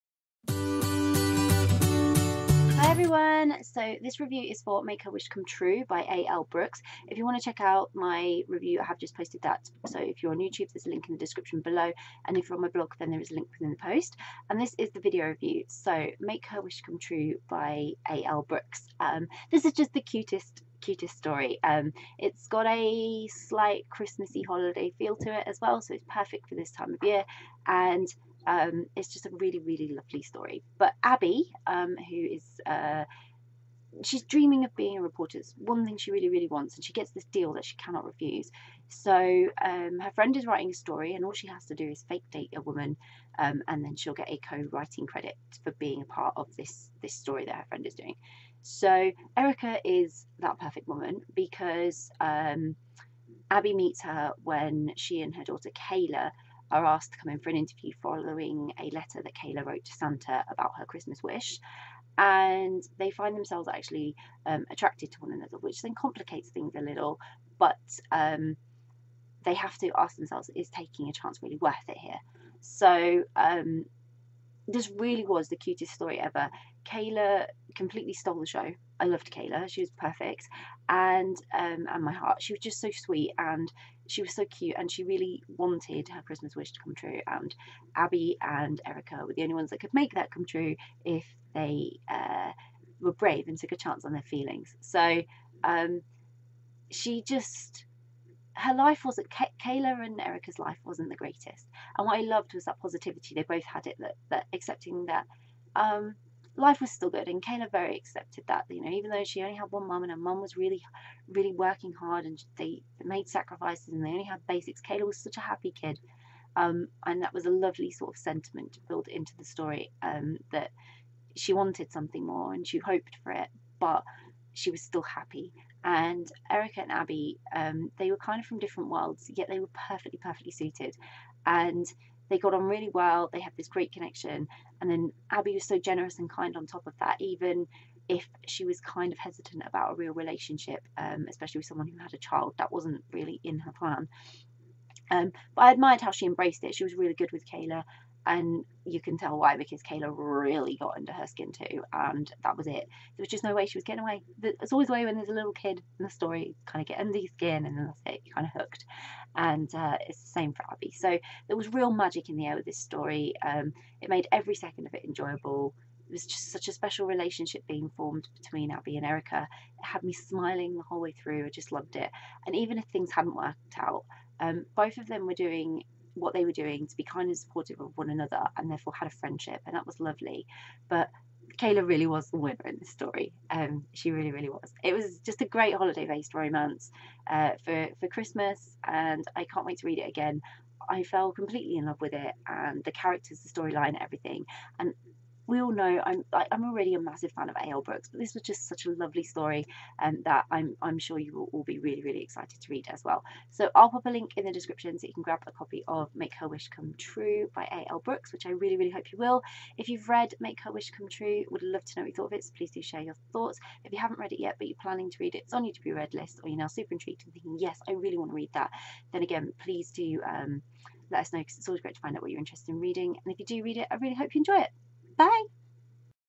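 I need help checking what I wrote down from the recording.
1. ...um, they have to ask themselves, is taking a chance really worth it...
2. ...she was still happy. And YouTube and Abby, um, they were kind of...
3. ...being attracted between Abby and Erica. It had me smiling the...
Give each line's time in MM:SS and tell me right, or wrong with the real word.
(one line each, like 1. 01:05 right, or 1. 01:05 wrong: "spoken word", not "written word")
1. 01:08 right
2. 02:04 wrong: "Erica", not "YouTube"
3. 02:47 wrong: "formed", not "attracted".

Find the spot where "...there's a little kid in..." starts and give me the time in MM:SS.
02:35.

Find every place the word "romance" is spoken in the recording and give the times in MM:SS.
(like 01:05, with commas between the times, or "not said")
03:06.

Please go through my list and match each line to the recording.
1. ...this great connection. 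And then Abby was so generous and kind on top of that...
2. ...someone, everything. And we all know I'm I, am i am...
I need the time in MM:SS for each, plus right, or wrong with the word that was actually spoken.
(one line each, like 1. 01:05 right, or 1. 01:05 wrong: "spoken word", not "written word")
1. 02:13 right
2. 03:13 wrong: "storyline", not "someone".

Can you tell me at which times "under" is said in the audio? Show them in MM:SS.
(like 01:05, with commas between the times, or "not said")
02:30, 02:36.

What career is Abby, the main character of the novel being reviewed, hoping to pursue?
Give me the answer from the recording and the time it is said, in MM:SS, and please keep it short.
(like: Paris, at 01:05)
Reporter, at 00:35.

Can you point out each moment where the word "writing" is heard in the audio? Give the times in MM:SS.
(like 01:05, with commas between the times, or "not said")
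00:40, 00:44.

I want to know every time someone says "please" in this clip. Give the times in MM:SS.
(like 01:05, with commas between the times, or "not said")
03:32, 03:39.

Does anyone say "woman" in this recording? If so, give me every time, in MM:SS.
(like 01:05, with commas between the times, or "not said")
00:42, 00:50.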